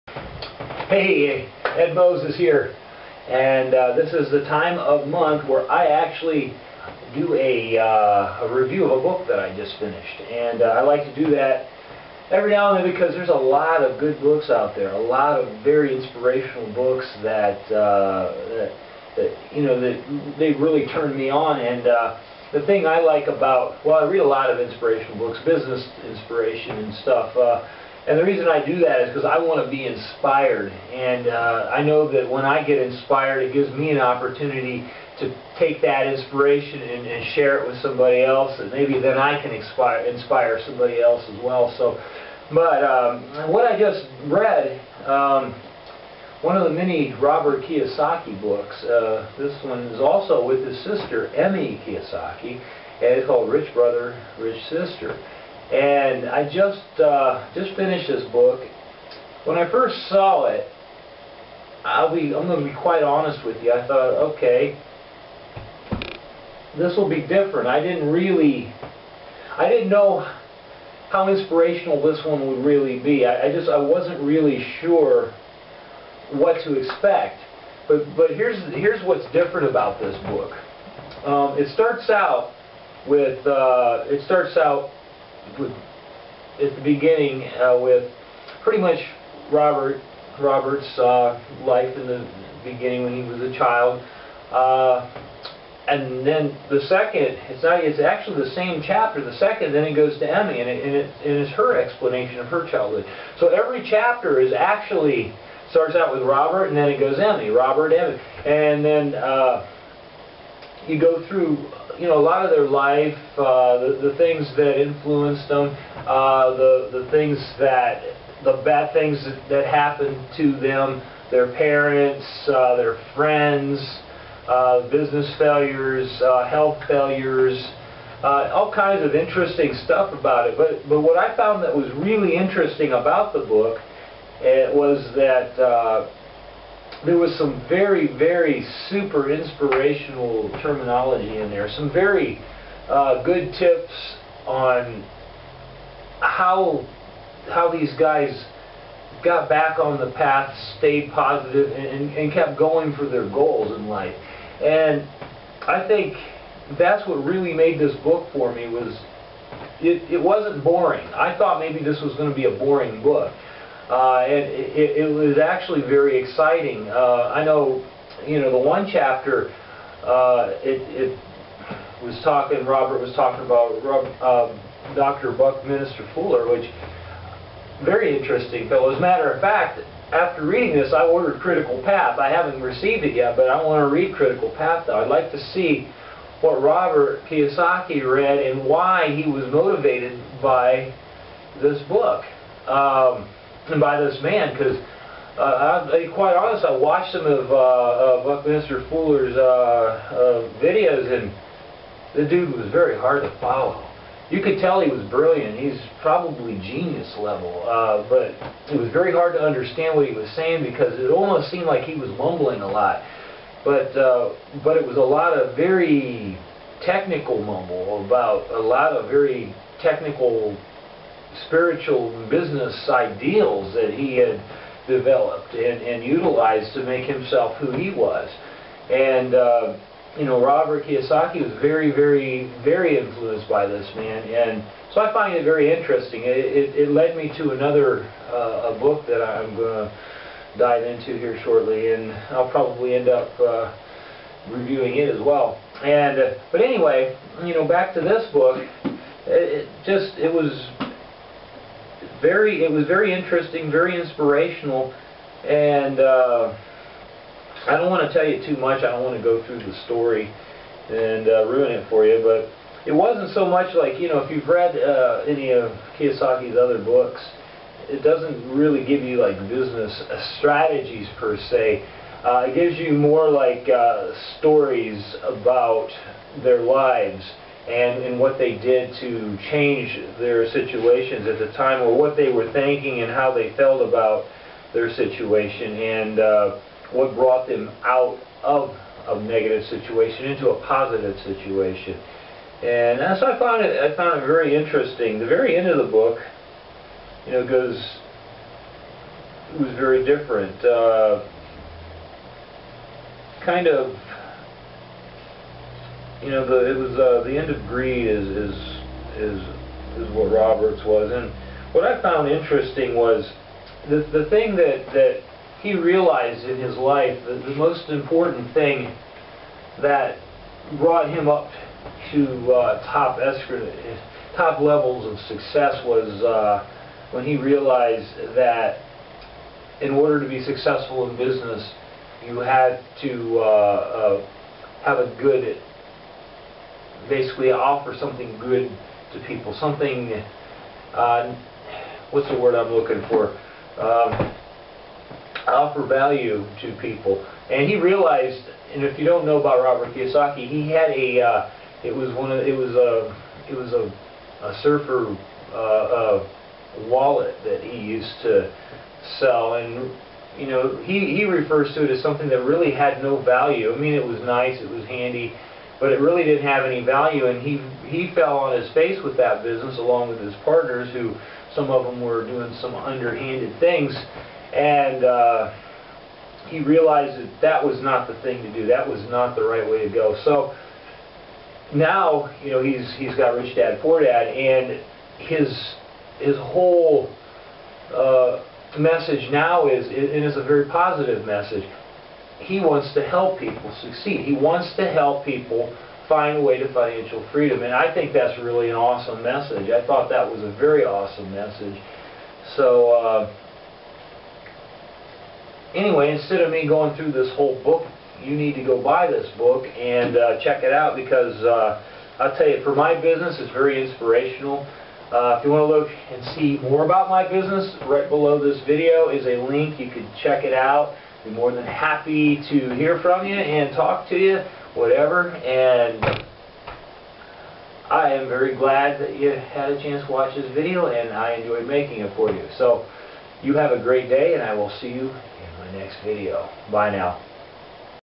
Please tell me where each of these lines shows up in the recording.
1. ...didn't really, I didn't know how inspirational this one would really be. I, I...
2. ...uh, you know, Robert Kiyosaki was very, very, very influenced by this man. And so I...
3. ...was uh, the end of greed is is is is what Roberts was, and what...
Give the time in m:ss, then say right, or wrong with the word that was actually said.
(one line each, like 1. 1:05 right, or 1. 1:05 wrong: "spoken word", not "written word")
1. 1:07 right
2. 3:49 right
3. 5:06 right.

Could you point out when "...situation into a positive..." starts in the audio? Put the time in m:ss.
4:49.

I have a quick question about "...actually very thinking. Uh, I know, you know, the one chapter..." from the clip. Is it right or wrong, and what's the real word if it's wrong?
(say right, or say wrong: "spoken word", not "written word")
wrong: "exciting", not "thinking".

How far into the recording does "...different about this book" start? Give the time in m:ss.
1:19.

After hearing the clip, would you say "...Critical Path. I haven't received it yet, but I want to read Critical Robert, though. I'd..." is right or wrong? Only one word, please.
wrong.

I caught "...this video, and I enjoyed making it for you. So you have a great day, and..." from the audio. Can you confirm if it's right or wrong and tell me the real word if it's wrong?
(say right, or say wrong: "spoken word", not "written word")
right.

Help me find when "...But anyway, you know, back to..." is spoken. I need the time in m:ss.
4:06.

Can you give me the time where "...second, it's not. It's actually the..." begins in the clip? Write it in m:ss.
1:36.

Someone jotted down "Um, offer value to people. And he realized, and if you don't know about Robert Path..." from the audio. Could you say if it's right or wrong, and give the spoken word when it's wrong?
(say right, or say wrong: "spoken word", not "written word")
wrong: "Kiyosaki", not "Path".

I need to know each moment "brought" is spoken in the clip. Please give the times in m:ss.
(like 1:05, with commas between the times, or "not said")
4:47, 5:20.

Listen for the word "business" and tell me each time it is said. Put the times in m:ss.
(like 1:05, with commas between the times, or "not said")
0:25, 2:04, 3:42, 4:29, 5:31, 6:09, 6:52, 6:57.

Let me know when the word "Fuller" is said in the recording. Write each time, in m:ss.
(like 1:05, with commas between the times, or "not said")
2:56, 3:18.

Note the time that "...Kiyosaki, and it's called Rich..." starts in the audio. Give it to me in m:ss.
0:51.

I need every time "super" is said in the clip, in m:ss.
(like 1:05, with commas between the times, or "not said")
2:18.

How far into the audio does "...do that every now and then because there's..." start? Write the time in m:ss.
0:11.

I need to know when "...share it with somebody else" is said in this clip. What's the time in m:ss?
0:37.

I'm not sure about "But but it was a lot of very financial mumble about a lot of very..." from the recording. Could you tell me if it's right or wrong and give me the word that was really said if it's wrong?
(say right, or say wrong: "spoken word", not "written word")
wrong: "technical", not "financial".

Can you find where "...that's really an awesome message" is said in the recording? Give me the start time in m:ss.
6:38.